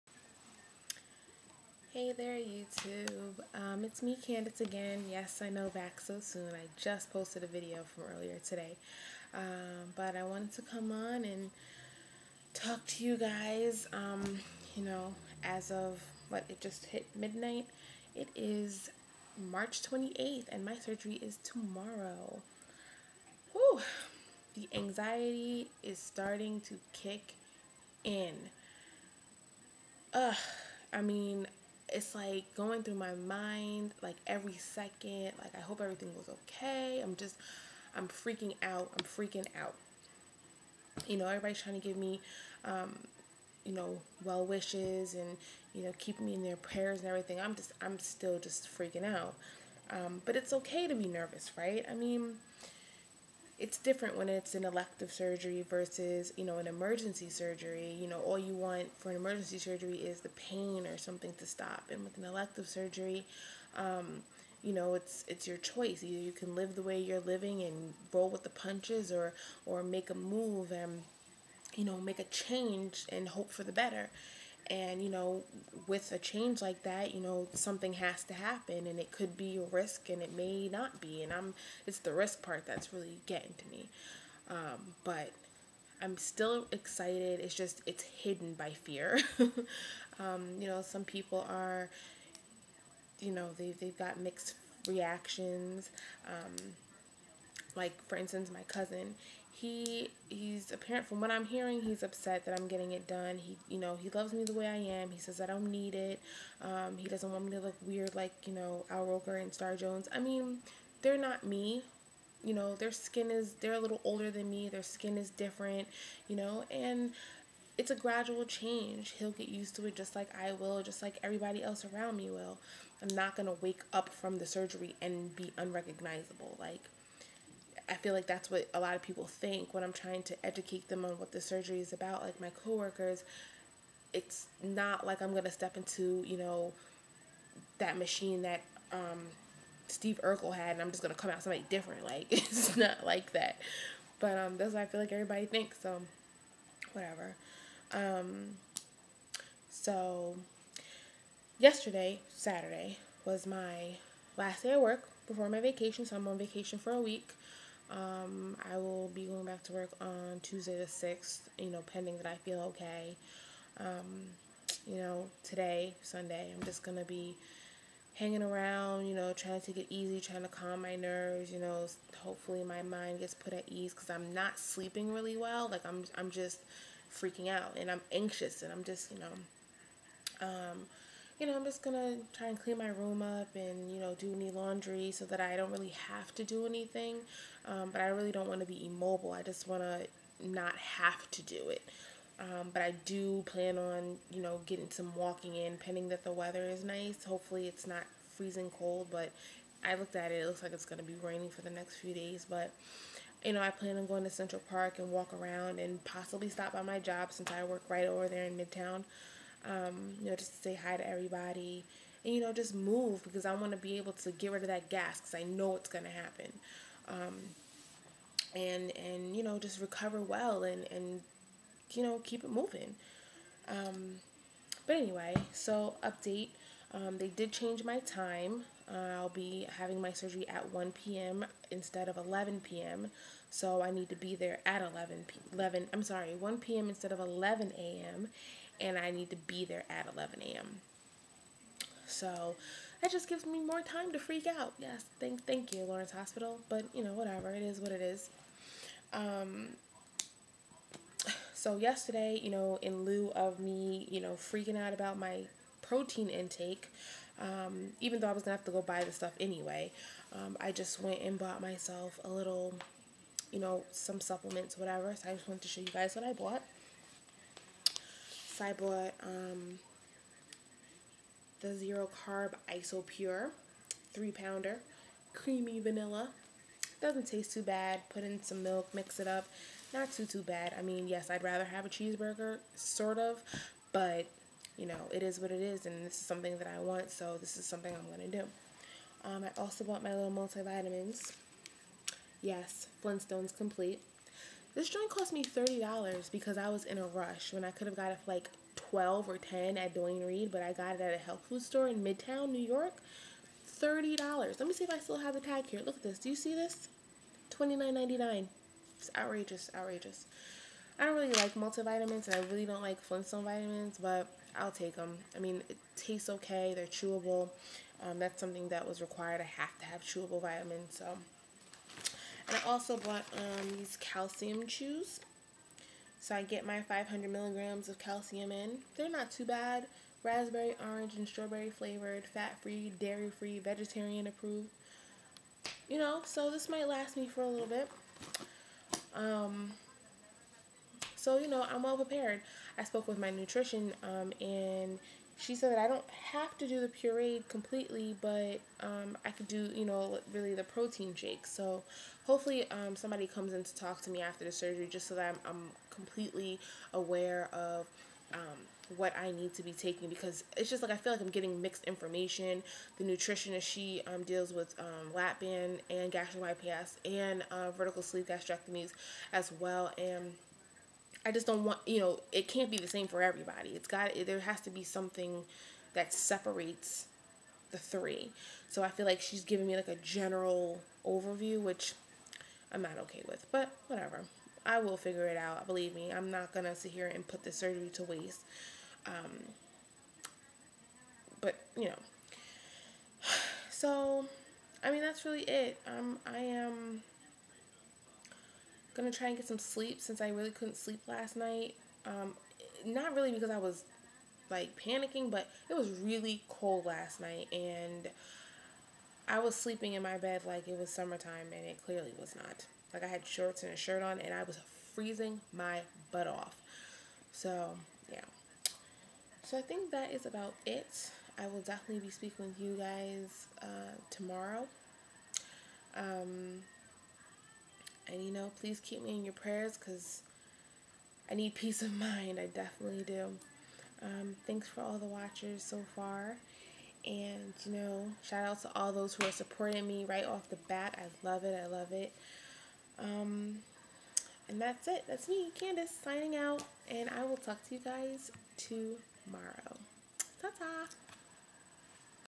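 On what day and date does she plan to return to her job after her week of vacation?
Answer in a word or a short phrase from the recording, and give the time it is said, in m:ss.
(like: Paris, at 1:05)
Tuesday the 6th, at 2:40.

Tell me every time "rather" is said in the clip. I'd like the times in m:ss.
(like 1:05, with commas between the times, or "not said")
4:41.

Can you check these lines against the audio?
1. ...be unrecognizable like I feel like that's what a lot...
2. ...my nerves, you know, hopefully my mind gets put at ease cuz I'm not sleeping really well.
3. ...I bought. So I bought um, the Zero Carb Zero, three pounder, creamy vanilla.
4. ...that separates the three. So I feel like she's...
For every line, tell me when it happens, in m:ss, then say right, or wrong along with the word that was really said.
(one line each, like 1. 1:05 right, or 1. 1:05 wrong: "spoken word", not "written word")
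1. 2:05 right
2. 2:50 right
3. 4:26 wrong: "Isopure", not "Zero"
4. 6:15 right.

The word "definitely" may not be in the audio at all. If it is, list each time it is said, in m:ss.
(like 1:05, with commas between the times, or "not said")
7:01, 7:12.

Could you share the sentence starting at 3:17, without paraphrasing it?
Hopefully it's not freezing cold, but I looked at it.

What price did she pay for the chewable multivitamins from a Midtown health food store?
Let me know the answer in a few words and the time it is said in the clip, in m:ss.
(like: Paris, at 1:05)
$29.99, at 5:07.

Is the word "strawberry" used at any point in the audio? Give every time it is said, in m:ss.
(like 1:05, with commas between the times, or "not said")
5:31.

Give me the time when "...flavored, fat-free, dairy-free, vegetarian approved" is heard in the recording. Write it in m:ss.
5:31.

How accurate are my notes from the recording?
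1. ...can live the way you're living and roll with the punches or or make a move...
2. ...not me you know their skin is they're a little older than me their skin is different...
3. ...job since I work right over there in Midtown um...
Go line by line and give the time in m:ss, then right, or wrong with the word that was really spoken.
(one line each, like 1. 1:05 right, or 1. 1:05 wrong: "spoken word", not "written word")
1. 1:06 right
2. 1:51 right
3. 3:26 right.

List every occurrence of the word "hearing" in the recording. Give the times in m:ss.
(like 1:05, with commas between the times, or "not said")
1:41.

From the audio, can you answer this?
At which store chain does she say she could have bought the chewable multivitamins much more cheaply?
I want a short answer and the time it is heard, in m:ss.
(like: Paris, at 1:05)
Duane Reade, at 4:59.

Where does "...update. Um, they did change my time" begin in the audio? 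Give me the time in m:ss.
3:46.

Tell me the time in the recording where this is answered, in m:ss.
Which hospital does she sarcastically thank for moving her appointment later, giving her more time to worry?
4:05.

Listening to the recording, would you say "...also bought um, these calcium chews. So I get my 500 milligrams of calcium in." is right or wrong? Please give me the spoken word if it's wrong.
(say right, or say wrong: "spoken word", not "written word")
right.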